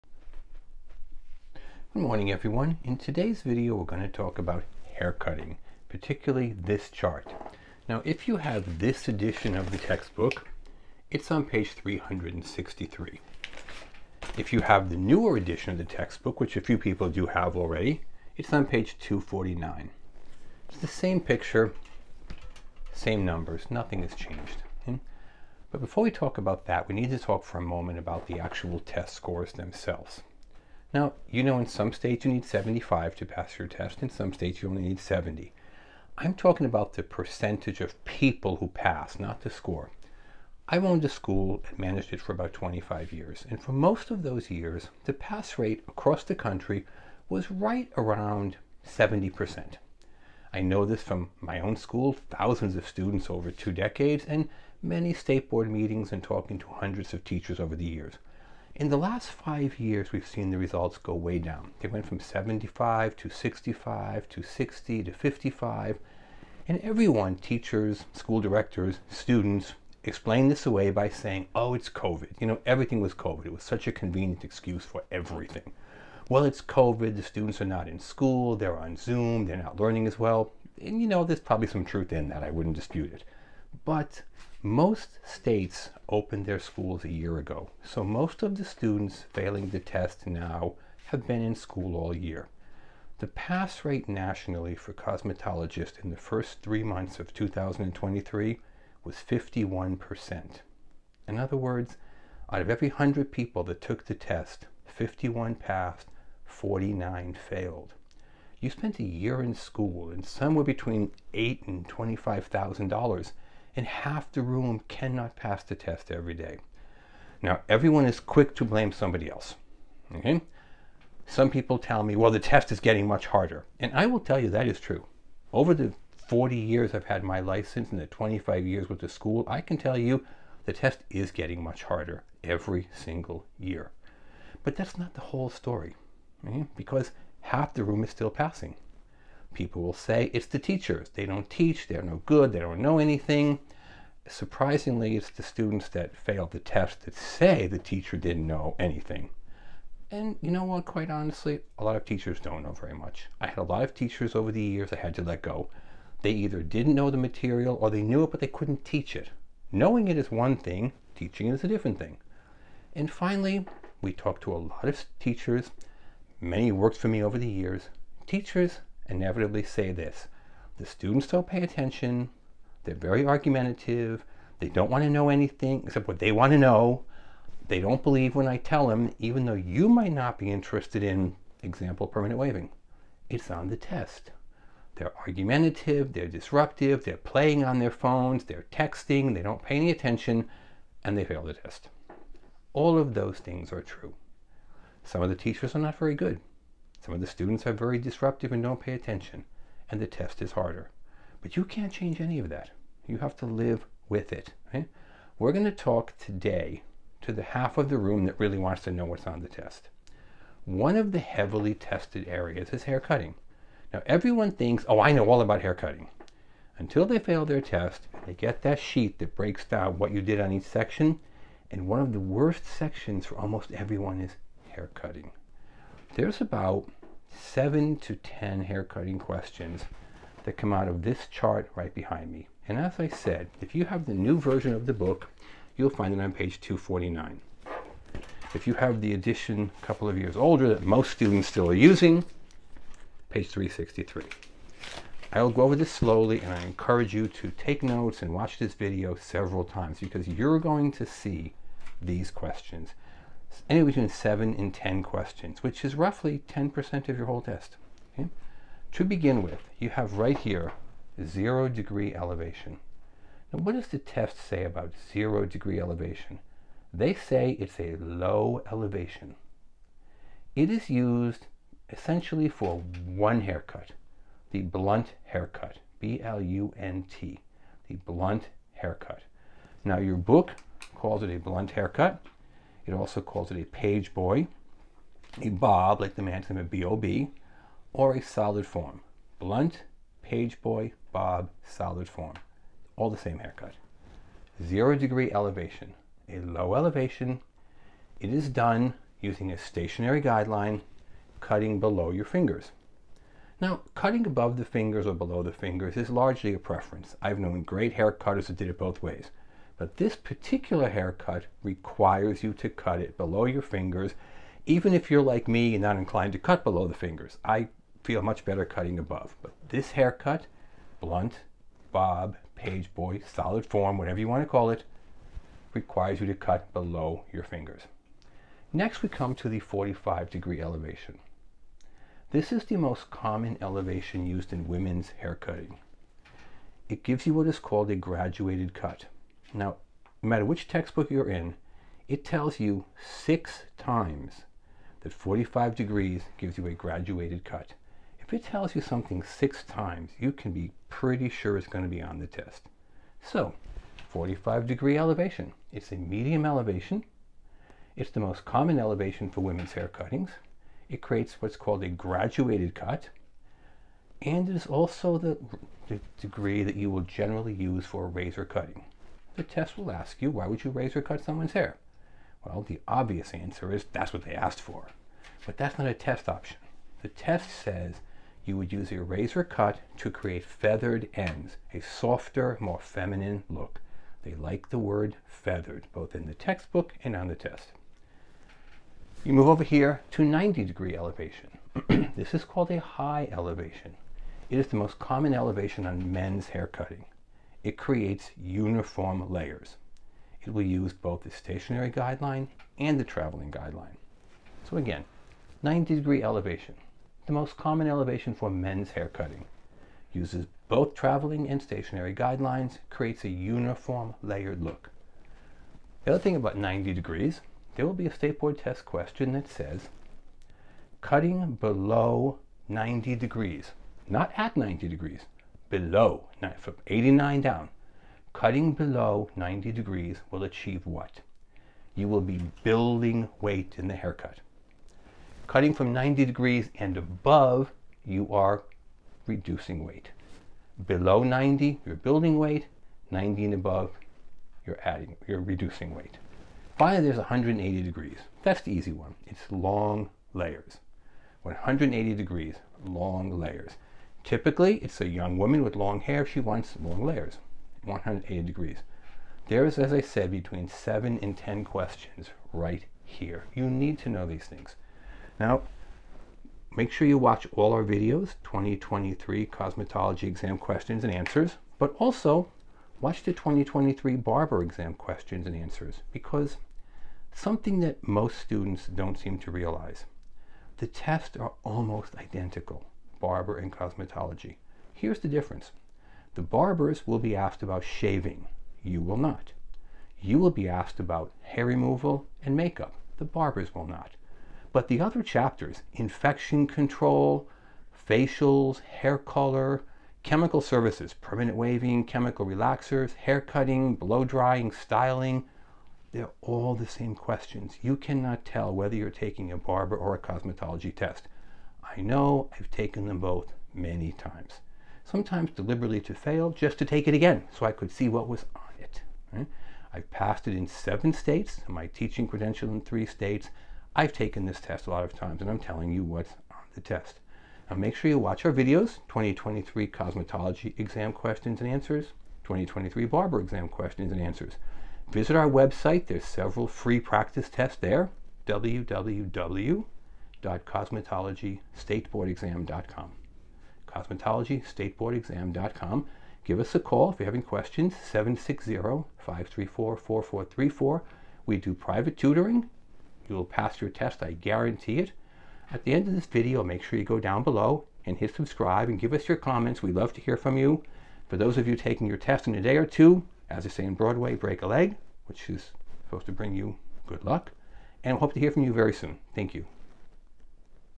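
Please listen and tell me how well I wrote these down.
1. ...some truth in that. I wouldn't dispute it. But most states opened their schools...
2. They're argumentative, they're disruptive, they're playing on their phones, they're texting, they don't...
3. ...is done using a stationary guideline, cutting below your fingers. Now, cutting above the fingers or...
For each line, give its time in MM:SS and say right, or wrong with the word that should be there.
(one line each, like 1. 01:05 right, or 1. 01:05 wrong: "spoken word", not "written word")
1. 01:21 right
2. 03:04 right
3. 04:58 right.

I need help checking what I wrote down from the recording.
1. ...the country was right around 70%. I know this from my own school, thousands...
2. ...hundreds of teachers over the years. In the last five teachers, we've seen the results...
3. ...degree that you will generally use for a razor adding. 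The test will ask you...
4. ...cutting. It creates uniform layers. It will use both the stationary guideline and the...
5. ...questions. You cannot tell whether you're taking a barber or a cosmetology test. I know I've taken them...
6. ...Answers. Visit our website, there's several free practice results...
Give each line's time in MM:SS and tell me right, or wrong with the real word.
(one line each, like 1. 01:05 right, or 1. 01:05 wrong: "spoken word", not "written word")
1. 00:46 right
2. 00:56 wrong: "years", not "teachers"
3. 06:06 wrong: "cutting", not "adding"
4. 06:36 right
5. 08:27 right
6. 08:54 wrong: "tests", not "results".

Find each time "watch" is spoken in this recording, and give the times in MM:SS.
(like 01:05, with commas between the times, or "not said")
04:08, 07:47, 07:52, 08:48.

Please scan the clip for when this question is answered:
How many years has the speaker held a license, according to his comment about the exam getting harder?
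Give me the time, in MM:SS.
02:06.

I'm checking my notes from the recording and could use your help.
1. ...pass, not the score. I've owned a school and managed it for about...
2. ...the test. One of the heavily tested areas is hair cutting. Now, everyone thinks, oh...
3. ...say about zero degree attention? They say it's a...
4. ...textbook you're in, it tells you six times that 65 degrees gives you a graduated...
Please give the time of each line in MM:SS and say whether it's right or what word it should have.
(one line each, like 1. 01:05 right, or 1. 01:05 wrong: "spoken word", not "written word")
1. 00:38 right
2. 03:29 right
3. 04:24 wrong: "elevation", not "attention"
4. 05:40 wrong: "45", not "65".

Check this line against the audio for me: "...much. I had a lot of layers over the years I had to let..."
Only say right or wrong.
wrong.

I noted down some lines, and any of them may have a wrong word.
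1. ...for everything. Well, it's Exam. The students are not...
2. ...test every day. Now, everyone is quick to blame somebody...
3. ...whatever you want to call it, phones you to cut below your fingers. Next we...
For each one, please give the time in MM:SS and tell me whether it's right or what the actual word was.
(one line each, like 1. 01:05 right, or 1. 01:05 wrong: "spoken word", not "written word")
1. 01:14 wrong: "COVID", not "Exam"
2. 01:55 right
3. 05:23 wrong: "requires", not "phones".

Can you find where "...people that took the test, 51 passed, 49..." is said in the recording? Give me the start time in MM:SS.
01:43.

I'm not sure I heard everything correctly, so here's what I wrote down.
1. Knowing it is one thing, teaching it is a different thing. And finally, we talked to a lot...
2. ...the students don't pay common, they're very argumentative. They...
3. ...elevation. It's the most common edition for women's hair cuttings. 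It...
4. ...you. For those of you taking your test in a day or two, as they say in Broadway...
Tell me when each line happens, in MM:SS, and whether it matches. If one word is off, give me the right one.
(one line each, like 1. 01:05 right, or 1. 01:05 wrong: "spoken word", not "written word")
1. 02:39 right
2. 02:50 wrong: "attention", not "common"
3. 05:56 wrong: "elevation", not "edition"
4. 09:20 right.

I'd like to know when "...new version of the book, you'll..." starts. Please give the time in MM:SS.
03:54.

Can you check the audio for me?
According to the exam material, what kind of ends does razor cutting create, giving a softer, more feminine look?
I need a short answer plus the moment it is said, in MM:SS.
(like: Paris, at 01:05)
Feathered ends, at 06:20.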